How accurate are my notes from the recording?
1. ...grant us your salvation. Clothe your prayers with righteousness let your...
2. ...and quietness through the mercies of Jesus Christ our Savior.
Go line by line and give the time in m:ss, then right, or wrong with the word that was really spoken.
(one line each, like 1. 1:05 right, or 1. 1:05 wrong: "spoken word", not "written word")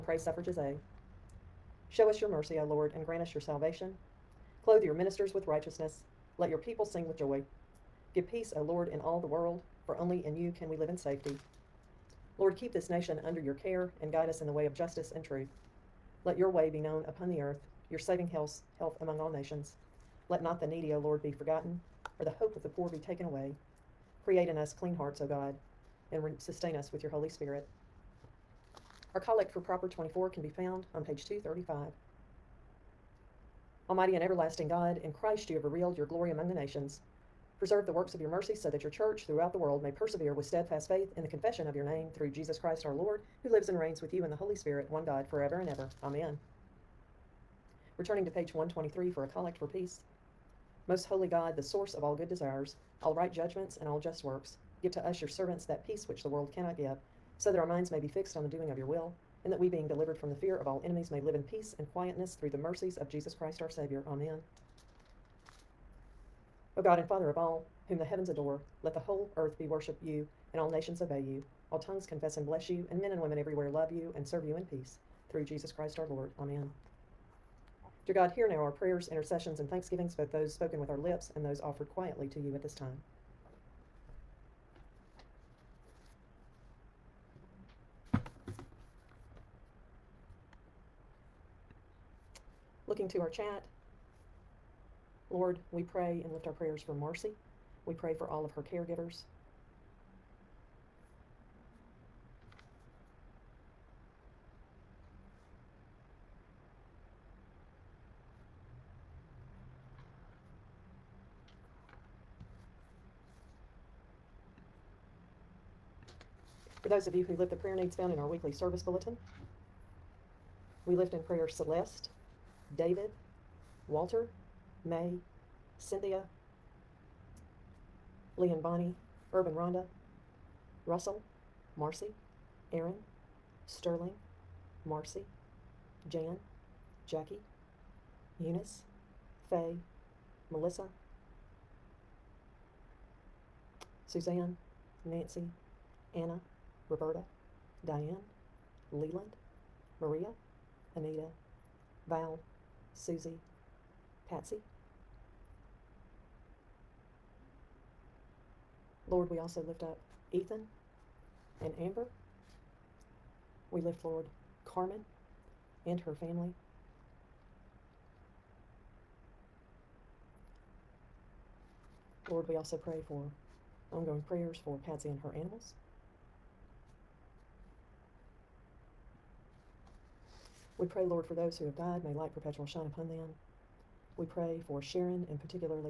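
1. 0:03 wrong: "ministers", not "prayers"
2. 1:01 right.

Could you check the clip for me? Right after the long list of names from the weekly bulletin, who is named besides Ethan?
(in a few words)
Amber.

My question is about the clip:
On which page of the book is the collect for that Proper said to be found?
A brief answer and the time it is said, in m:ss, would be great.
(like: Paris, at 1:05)
235, at 0:31.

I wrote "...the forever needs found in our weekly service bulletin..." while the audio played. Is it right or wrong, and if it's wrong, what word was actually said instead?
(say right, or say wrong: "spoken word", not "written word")
wrong: "prayer", not "forever".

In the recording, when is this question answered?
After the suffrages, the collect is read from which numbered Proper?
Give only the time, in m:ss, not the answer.
0:29.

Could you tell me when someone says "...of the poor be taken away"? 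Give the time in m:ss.
0:22.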